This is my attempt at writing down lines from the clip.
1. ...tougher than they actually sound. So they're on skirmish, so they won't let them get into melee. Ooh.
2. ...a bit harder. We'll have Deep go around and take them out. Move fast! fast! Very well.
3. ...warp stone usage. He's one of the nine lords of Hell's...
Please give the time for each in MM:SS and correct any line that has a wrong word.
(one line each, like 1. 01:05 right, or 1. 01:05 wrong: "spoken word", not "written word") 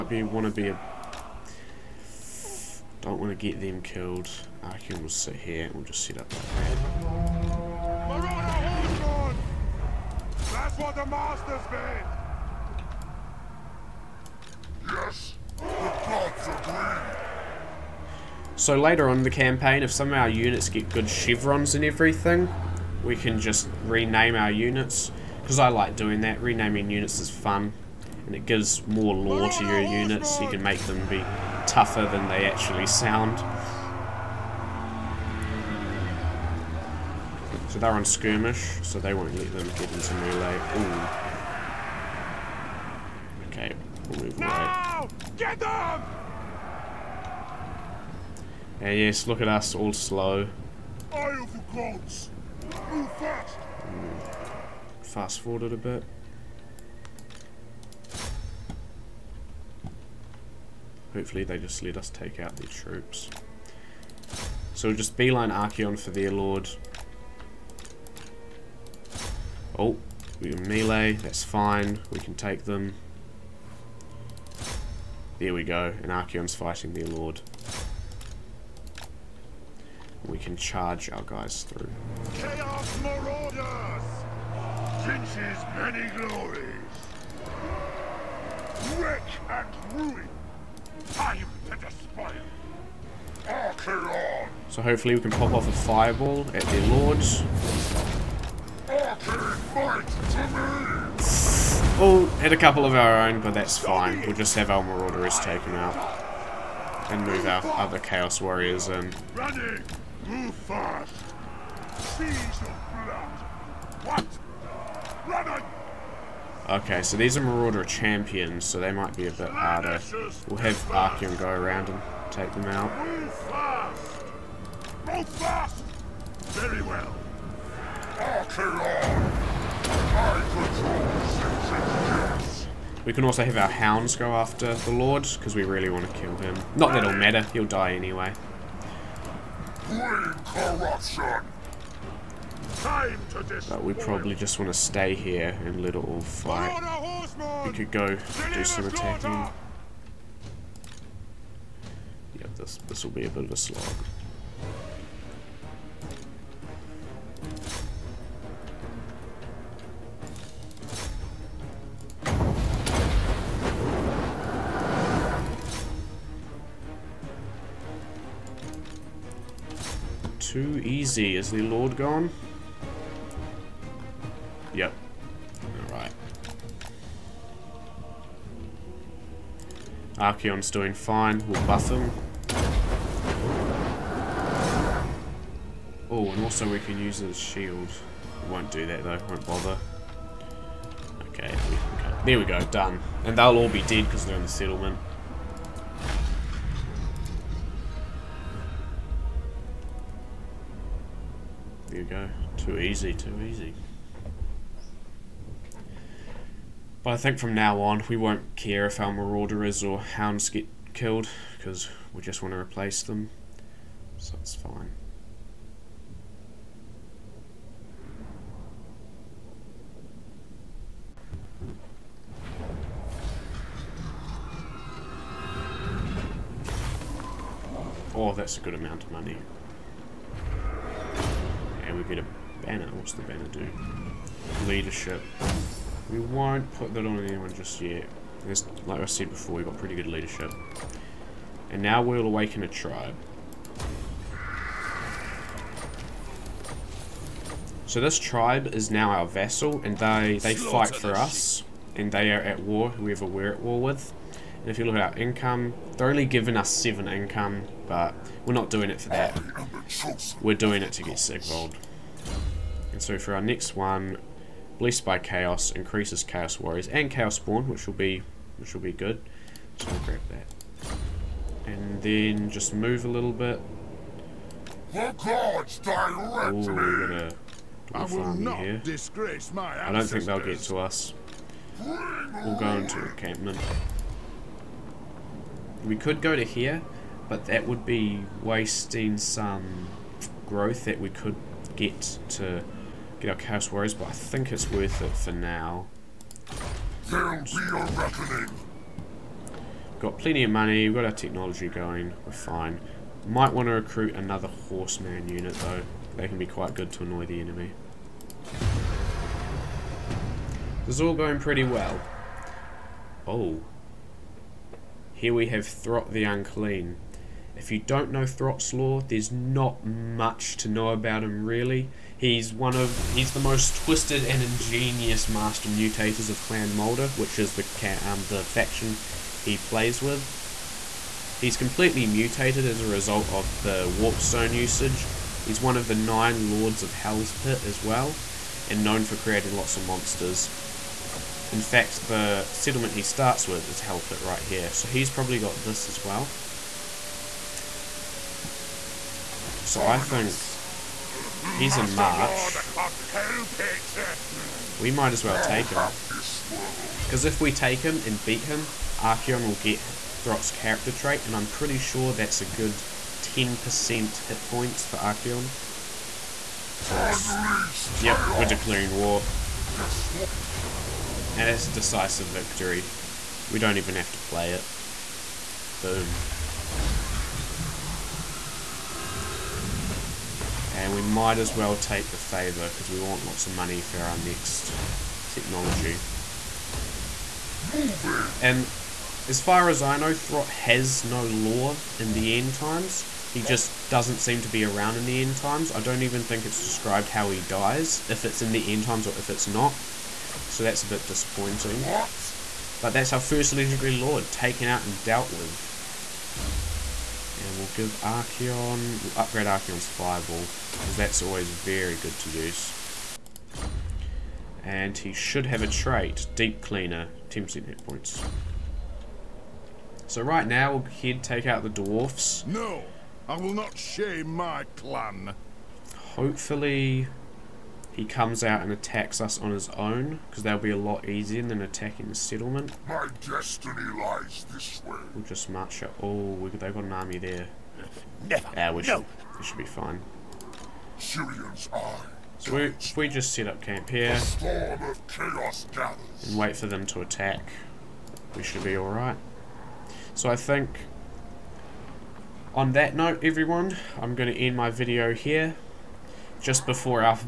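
1. 00:31 right
2. 01:59 wrong: "Archaon", not "Deep"
3. 05:33 right.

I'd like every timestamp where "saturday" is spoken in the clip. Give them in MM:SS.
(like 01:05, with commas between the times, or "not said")
not said.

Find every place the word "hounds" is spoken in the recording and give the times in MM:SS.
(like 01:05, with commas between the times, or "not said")
02:13, 03:30.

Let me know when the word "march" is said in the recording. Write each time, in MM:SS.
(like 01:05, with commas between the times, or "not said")
05:51, 07:15.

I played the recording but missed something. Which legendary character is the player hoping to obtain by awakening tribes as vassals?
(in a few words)
Sigvald.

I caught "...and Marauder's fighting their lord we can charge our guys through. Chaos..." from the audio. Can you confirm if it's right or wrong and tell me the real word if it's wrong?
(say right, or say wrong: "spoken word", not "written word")
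wrong: "Archaon", not "Marauder".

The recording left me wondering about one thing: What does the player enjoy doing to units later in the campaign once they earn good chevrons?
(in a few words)
Renaming units.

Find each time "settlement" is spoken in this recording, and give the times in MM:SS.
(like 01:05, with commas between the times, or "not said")
03:14, 05:42, 07:12.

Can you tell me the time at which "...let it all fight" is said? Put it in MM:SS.
02:25.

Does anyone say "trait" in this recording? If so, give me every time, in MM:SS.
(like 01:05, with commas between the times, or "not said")
06:00, 06:55.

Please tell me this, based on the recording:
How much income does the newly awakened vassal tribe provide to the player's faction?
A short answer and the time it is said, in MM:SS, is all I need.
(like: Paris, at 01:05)
7, at 04:16.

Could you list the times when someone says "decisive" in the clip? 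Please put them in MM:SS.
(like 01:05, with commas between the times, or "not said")
06:11.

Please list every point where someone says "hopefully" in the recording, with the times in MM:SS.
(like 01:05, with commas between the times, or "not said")
01:01, 01:34, 07:06.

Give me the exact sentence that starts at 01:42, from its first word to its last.
Oh, hit a couple of our own, but that's fine.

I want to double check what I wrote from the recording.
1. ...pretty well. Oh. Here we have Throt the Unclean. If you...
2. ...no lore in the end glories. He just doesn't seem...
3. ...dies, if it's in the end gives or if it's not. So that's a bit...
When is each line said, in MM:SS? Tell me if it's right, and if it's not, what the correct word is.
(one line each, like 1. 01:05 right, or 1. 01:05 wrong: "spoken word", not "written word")
1. 05:11 right
2. 06:31 wrong: "times", not "glories"
3. 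06:37 wrong: "times", not "gives".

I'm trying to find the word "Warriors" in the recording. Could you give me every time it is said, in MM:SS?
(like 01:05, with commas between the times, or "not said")
01:48, 04:26, 04:53.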